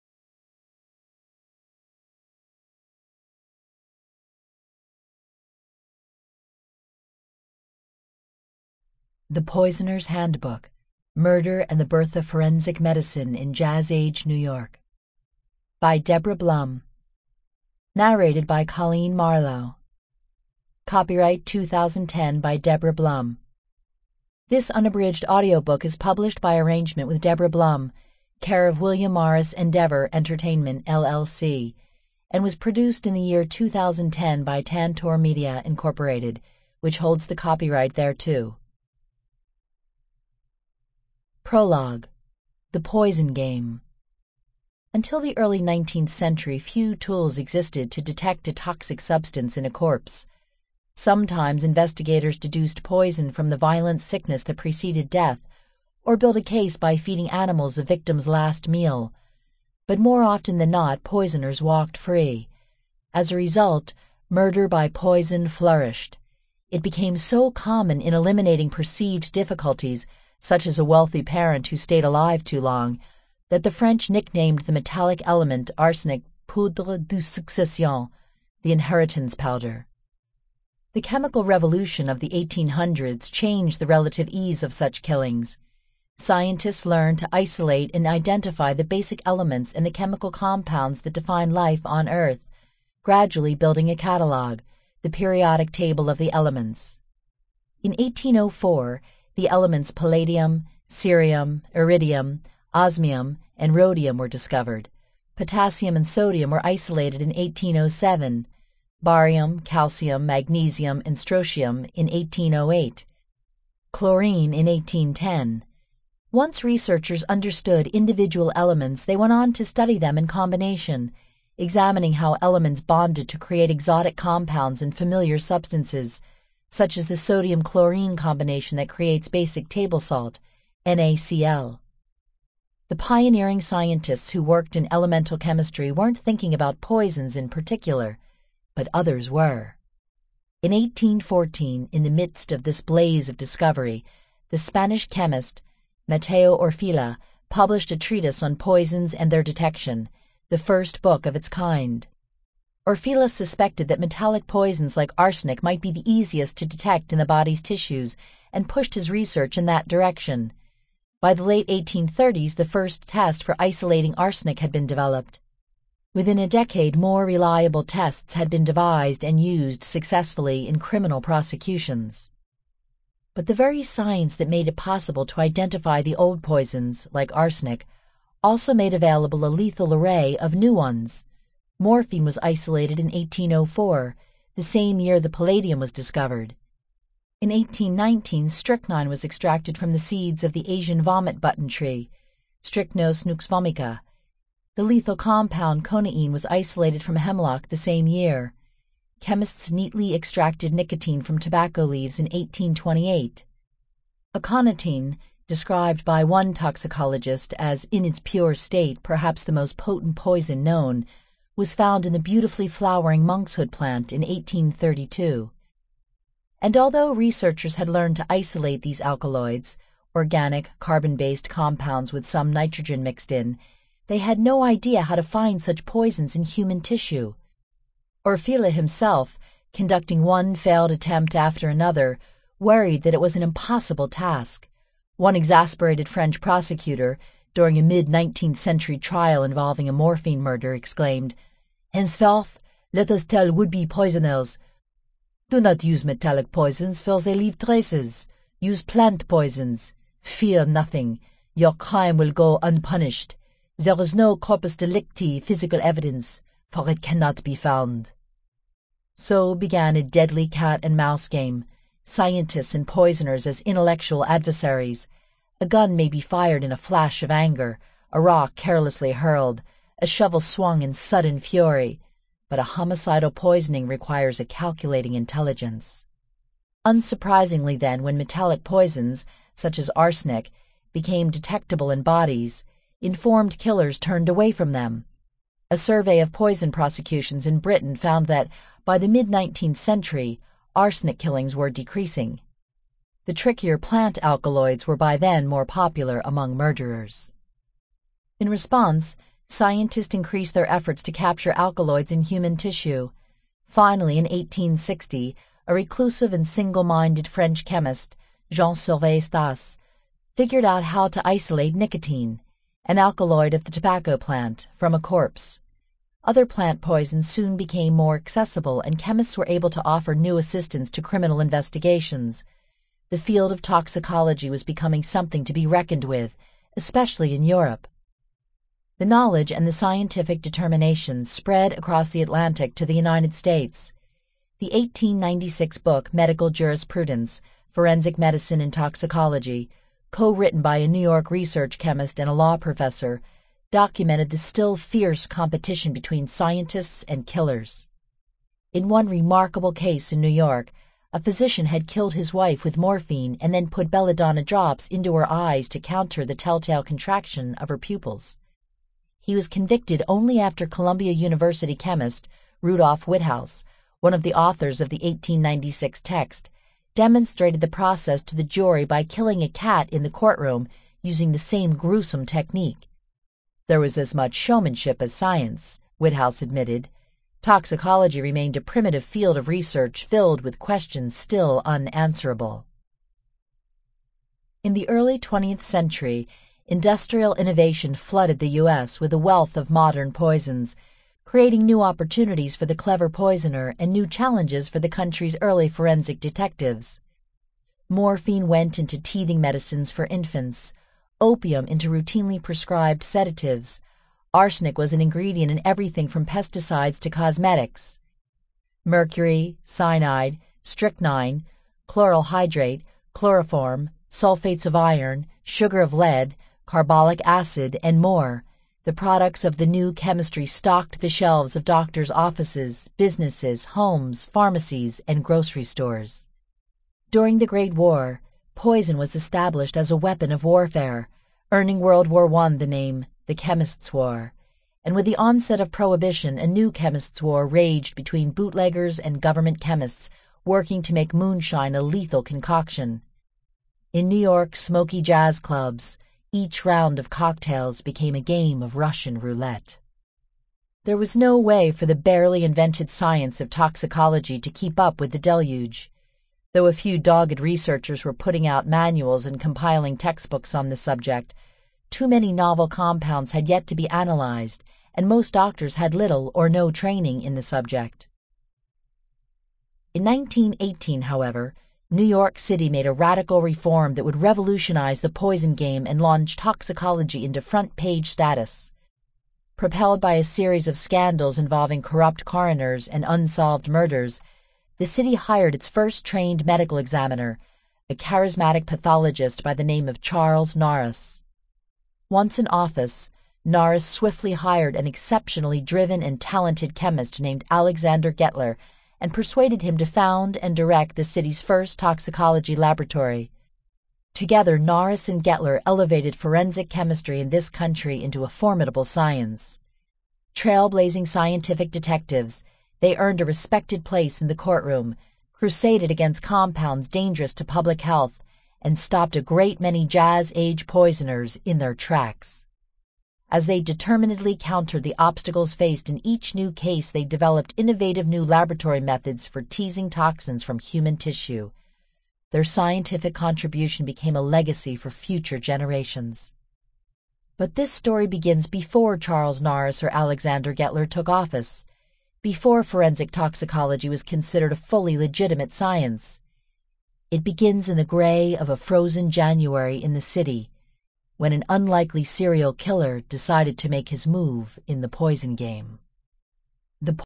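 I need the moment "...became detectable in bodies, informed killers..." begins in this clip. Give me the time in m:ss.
4:40.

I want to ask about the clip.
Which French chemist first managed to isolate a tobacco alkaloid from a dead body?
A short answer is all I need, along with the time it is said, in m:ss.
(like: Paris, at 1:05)
Jean Sylvain Stas, at 5:08.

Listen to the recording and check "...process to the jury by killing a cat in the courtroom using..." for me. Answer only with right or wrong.
right.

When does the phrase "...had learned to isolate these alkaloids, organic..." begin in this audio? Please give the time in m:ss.
3:37.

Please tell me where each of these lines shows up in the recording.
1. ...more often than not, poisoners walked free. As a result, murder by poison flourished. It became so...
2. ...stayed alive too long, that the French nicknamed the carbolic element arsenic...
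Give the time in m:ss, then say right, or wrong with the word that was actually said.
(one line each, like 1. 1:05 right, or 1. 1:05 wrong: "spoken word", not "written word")
1. 0:59 right
2. 1:11 wrong: "metallic", not "carbolic".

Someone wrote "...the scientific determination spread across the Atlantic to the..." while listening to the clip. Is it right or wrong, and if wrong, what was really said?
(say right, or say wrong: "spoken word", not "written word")
right.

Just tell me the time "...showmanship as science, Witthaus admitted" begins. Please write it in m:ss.
6:14.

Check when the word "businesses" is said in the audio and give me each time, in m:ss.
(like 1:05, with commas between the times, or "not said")
7:02.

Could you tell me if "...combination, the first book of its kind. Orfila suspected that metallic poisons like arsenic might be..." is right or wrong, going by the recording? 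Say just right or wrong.
wrong.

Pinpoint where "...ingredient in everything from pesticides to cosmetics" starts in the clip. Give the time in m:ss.
6:45.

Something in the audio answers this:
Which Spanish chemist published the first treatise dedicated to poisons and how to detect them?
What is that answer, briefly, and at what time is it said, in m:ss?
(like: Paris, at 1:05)
Mateo Orfila, at 2:26.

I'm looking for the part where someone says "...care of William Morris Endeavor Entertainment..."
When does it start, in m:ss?
0:28.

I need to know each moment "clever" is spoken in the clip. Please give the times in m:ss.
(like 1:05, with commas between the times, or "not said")
6:32.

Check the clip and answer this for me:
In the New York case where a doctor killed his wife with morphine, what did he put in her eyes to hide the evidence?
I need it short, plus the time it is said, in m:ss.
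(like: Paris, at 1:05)
belladonna drops, at 5:53.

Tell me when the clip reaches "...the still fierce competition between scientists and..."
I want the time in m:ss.
5:44.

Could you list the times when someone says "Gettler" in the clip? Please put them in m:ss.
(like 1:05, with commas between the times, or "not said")
8:18, 8:25, 9:00.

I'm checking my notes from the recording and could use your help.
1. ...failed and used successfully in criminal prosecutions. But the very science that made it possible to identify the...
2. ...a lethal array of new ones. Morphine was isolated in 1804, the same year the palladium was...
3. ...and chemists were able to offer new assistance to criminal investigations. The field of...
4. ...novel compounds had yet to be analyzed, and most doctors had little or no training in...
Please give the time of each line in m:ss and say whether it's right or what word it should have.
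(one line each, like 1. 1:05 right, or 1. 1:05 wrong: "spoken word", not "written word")
1. 2:48 wrong: "devised", not "failed"
2. 2:59 right
3. 5:18 right
4. 7:42 right.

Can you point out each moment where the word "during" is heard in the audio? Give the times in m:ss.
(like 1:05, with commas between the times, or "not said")
3:57, 7:07.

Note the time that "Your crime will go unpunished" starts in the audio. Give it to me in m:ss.
4:11.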